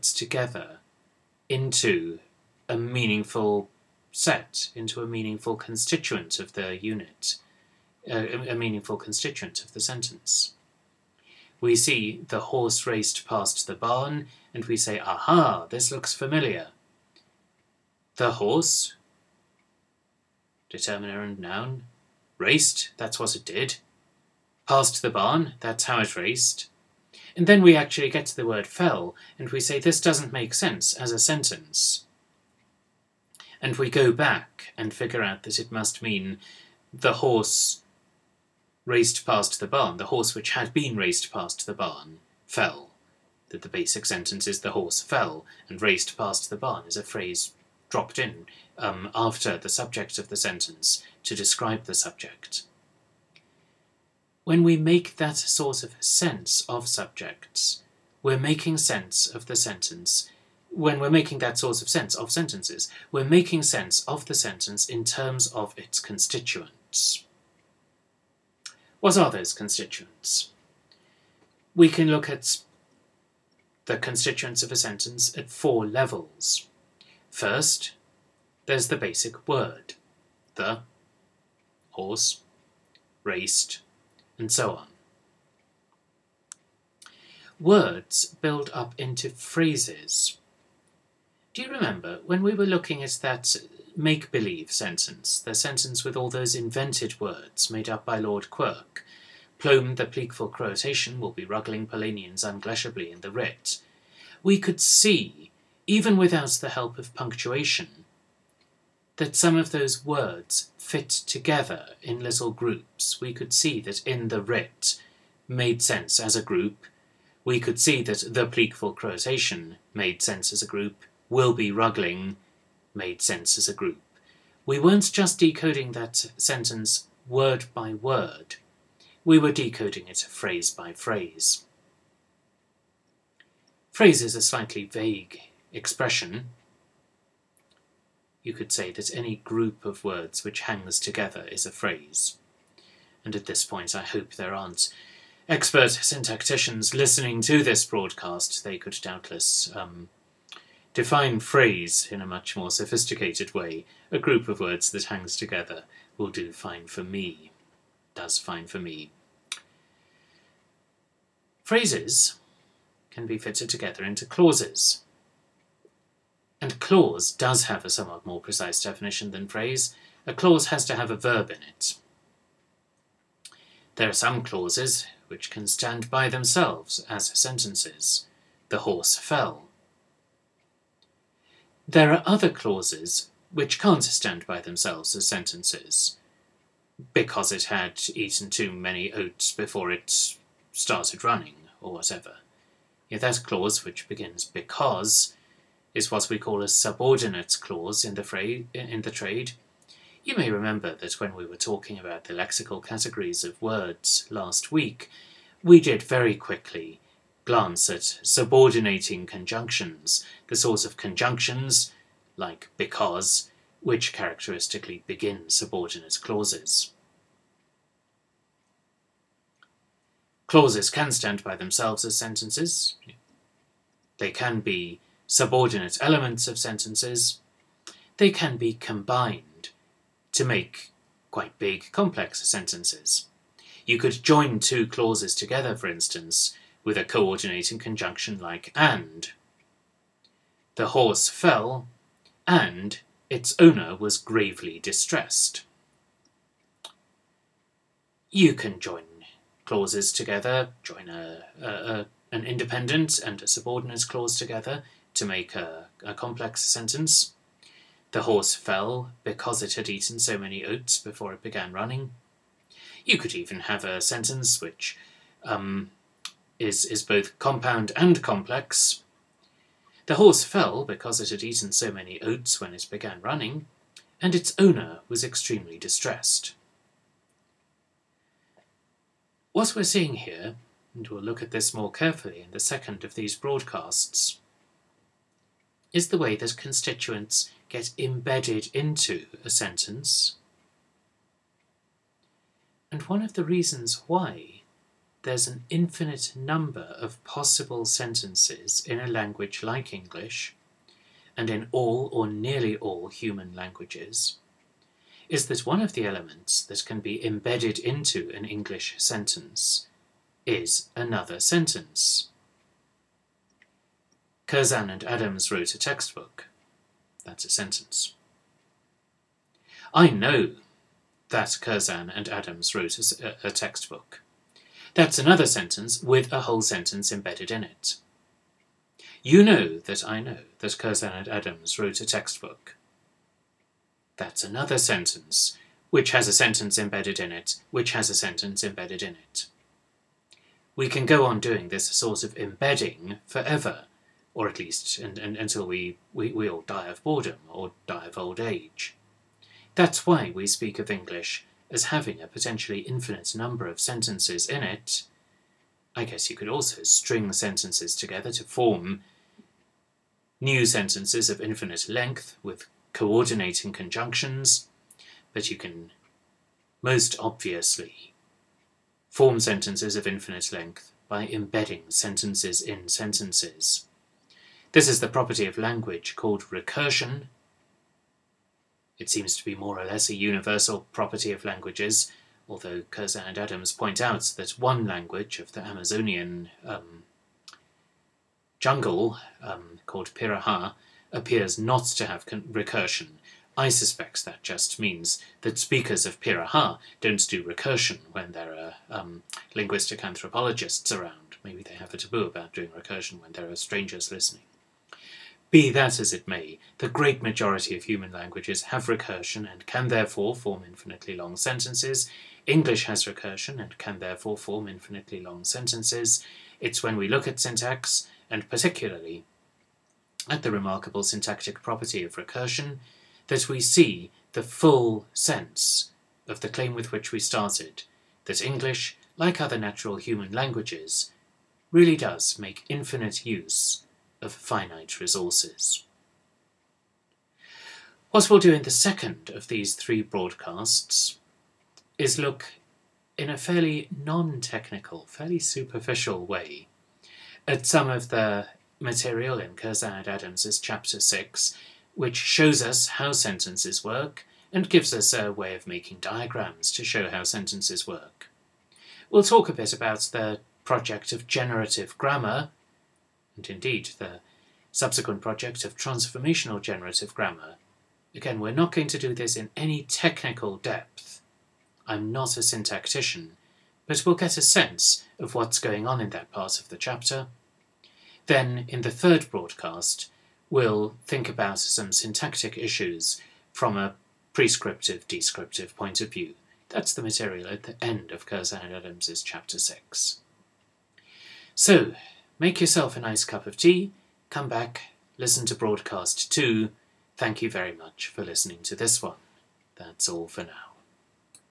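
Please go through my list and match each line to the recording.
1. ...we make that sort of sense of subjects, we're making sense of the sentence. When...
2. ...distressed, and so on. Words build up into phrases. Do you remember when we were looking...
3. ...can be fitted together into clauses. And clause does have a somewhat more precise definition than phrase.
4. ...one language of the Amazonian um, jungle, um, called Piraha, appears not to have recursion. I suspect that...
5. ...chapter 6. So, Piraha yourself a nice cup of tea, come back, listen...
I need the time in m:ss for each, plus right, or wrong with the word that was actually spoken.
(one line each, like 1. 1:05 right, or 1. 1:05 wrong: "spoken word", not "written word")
1. 0:54 right
2. 1:23 wrong: "raced", not "distressed"
3. 2:43 right
4. 6:24 right
5. 8:09 wrong: "Make", not "Piraha".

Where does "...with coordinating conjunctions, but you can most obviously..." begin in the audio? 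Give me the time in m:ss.
6:02.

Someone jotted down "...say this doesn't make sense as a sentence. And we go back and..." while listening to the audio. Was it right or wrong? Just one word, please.
right.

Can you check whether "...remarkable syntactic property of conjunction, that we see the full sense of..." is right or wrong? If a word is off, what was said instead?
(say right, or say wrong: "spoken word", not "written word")
wrong: "recursion", not "conjunction".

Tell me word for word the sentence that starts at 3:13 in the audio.
Yet that clause, which begins because, is what we call a subordinate clause in the, fra- in the trade.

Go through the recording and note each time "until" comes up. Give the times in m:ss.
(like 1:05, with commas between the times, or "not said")
5:45.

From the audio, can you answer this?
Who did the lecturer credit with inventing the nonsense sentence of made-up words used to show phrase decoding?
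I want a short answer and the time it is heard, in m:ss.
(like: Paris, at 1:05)
Lord Quirk, at 1:38.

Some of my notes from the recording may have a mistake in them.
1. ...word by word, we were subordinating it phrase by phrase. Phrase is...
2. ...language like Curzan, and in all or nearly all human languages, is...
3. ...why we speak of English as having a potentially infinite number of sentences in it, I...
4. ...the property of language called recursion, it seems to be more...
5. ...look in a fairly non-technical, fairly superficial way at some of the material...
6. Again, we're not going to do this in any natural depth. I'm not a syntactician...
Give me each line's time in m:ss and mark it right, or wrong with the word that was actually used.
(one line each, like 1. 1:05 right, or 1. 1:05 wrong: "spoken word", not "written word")
1. 2:07 wrong: "decoding", not "subordinating"
2. 4:59 wrong: "English", not "Curzan"
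3. 5:50 right
4. 6:15 right
5. 7:22 right
6. 7:48 wrong: "technical", not "natural".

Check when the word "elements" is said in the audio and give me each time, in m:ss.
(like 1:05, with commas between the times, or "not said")
3:46, 5:06.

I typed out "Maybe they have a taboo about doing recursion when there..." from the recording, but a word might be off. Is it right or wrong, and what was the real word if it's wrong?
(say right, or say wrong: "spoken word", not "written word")
right.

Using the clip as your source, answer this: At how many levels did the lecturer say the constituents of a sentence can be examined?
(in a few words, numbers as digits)
4.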